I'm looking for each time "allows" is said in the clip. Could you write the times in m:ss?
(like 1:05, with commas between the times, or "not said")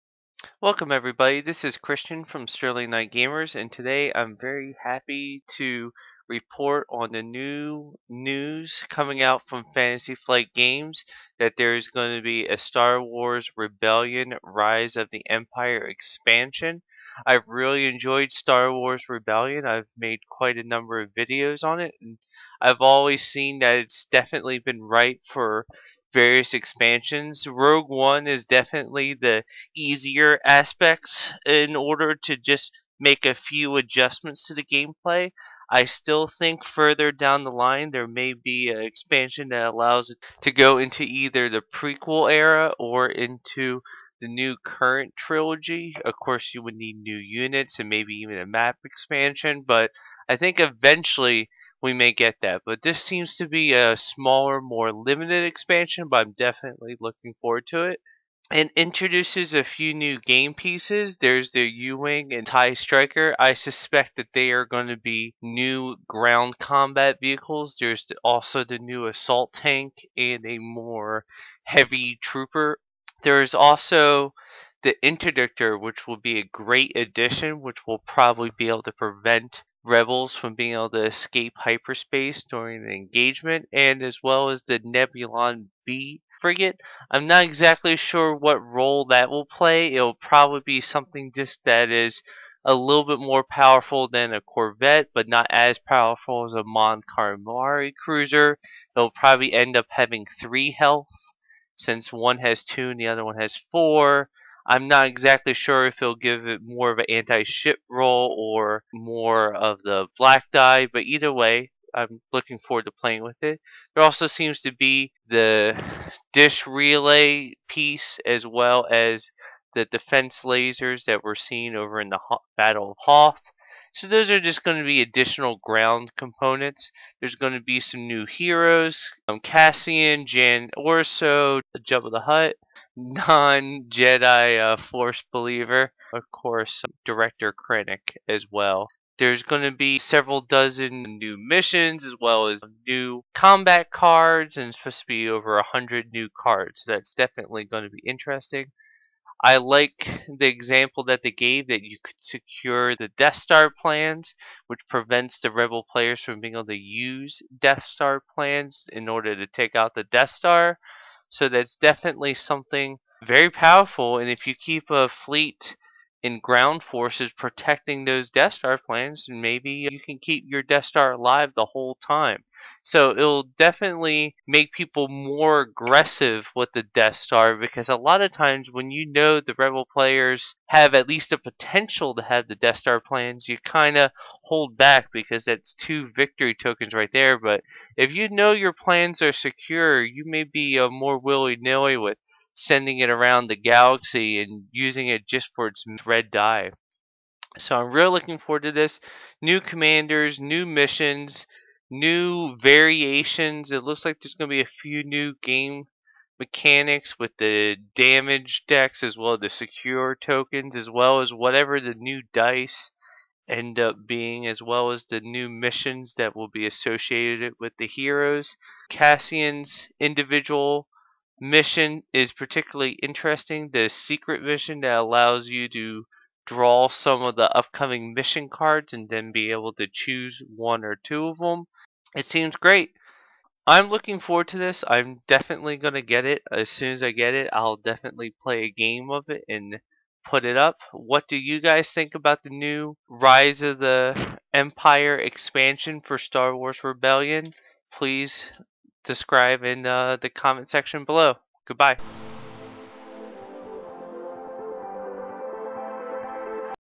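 0:39, 3:44.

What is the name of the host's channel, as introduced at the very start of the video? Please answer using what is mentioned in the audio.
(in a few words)
Sterling Knight Gamers.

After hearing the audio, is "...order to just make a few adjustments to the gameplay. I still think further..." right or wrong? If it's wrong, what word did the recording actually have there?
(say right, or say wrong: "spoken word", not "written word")
right.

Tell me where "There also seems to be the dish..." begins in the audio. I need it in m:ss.
1:53.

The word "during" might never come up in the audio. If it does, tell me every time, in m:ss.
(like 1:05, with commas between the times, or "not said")
1:22.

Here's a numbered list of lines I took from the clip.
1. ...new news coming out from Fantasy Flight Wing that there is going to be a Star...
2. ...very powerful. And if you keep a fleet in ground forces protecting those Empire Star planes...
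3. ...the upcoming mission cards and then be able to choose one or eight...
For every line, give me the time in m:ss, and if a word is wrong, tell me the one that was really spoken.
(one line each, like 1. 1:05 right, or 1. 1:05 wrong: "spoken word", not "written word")
1. 0:07 wrong: "Games", not "Wing"
2. 2:43 wrong: "Death", not "Empire"
3. 3:47 wrong: "two", not "eight".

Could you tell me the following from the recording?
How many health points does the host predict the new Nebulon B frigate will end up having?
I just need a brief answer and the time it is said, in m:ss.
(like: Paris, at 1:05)
3, at 1:40.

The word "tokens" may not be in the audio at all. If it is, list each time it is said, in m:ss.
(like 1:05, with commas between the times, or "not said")
3:06, 3:30.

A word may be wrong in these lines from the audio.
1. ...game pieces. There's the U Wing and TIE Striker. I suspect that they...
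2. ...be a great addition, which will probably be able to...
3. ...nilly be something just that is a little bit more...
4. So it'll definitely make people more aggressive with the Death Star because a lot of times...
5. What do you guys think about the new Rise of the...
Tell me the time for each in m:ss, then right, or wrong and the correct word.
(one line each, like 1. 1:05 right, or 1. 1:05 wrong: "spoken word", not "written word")
1. 1:00 right
2. 1:16 right
3. 1:30 wrong: "probably", not "nilly"
4. 2:52 right
5. 4:00 right.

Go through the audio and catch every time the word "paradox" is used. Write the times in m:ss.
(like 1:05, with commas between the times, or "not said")
not said.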